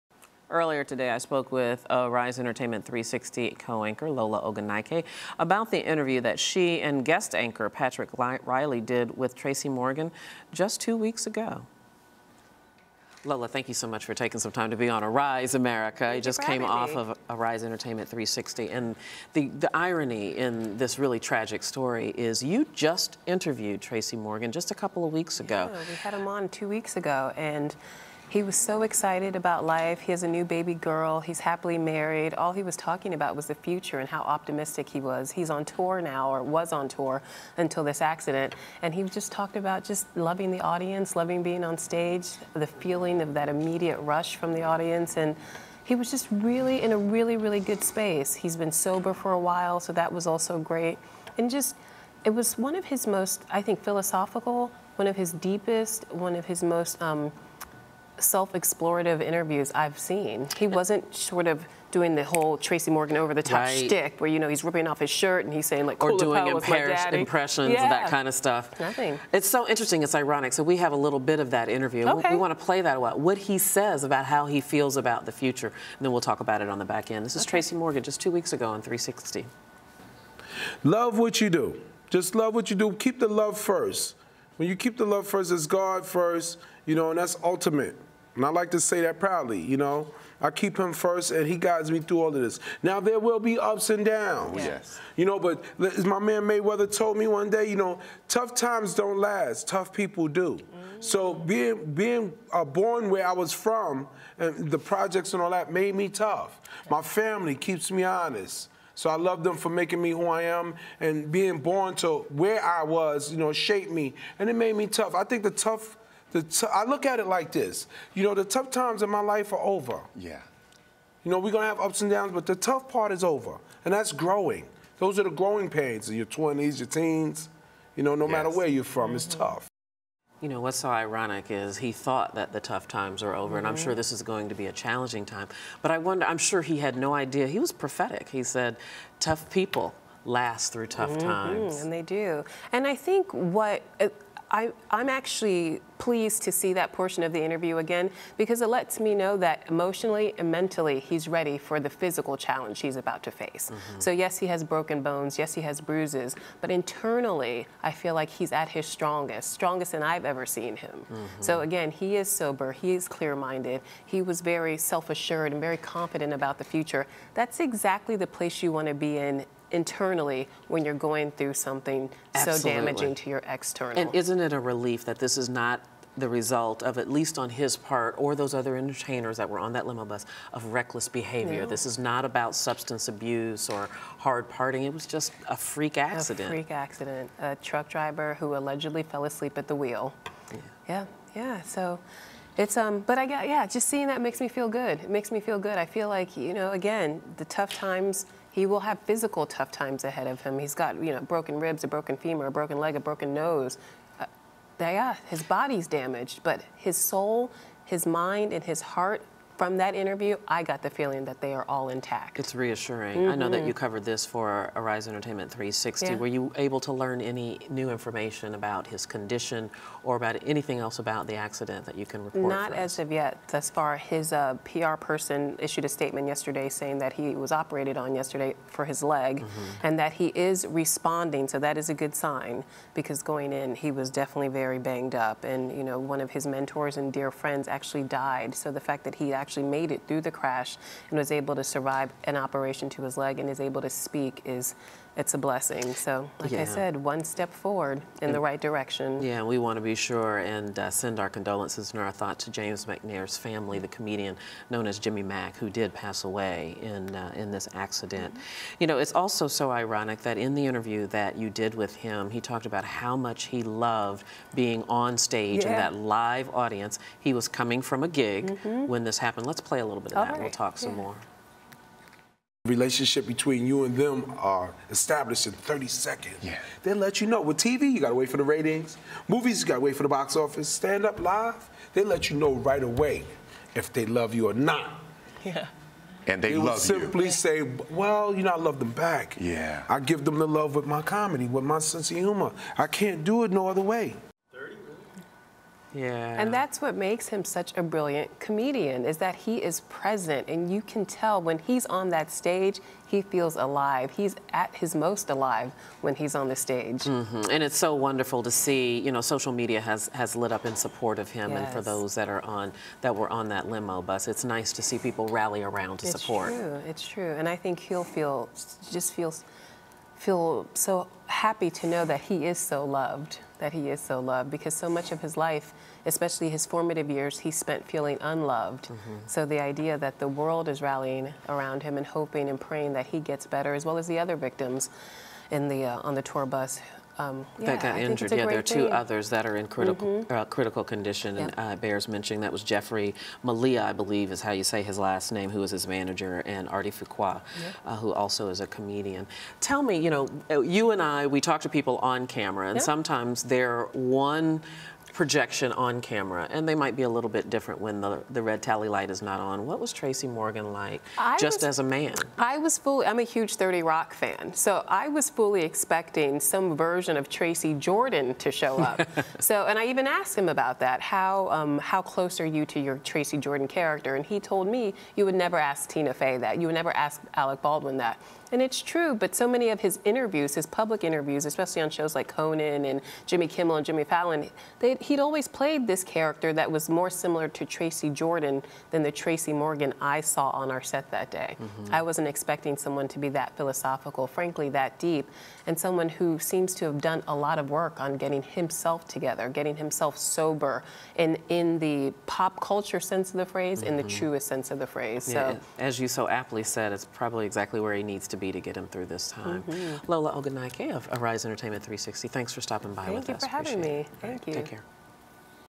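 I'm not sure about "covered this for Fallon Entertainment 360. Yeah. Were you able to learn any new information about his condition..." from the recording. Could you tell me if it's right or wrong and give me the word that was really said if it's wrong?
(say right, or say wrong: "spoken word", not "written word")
wrong: "Arise", not "Fallon".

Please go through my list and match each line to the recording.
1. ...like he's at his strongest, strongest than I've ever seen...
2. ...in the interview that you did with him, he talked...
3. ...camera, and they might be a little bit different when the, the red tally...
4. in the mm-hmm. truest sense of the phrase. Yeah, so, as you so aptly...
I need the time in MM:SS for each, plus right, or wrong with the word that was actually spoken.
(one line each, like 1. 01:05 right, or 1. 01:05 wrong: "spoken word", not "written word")
1. 02:38 right
2. 04:20 right
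3. 05:56 right
4. 06:43 right.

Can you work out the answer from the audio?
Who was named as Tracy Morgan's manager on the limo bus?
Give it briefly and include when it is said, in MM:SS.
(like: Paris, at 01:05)
Jeffrey Malia, at 05:42.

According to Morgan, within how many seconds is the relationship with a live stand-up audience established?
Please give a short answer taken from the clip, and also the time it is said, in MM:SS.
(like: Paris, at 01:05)
30 seconds, at 04:35.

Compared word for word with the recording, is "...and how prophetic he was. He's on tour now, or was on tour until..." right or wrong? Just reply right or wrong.
wrong.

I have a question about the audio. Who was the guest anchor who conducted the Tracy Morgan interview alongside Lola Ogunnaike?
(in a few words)
Patrick Riley.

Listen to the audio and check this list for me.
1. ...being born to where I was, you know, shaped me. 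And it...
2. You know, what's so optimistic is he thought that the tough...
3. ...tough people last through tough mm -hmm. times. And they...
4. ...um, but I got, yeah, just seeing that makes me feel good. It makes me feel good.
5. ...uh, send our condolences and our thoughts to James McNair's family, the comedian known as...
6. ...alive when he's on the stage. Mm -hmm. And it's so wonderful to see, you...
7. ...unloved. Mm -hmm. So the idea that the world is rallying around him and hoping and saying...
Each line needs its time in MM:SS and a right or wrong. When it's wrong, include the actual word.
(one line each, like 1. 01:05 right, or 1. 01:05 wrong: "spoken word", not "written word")
1. 01:51 right
2. 02:10 wrong: "ironic", not "optimistic"
3. 02:19 right
4. 03:12 right
5. 04:10 right
6. 05:05 right
7. 05:28 wrong: "praying", not "saying".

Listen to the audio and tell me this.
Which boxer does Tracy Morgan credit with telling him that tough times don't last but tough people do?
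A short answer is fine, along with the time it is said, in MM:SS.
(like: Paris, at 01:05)
Mayweather, at 01:36.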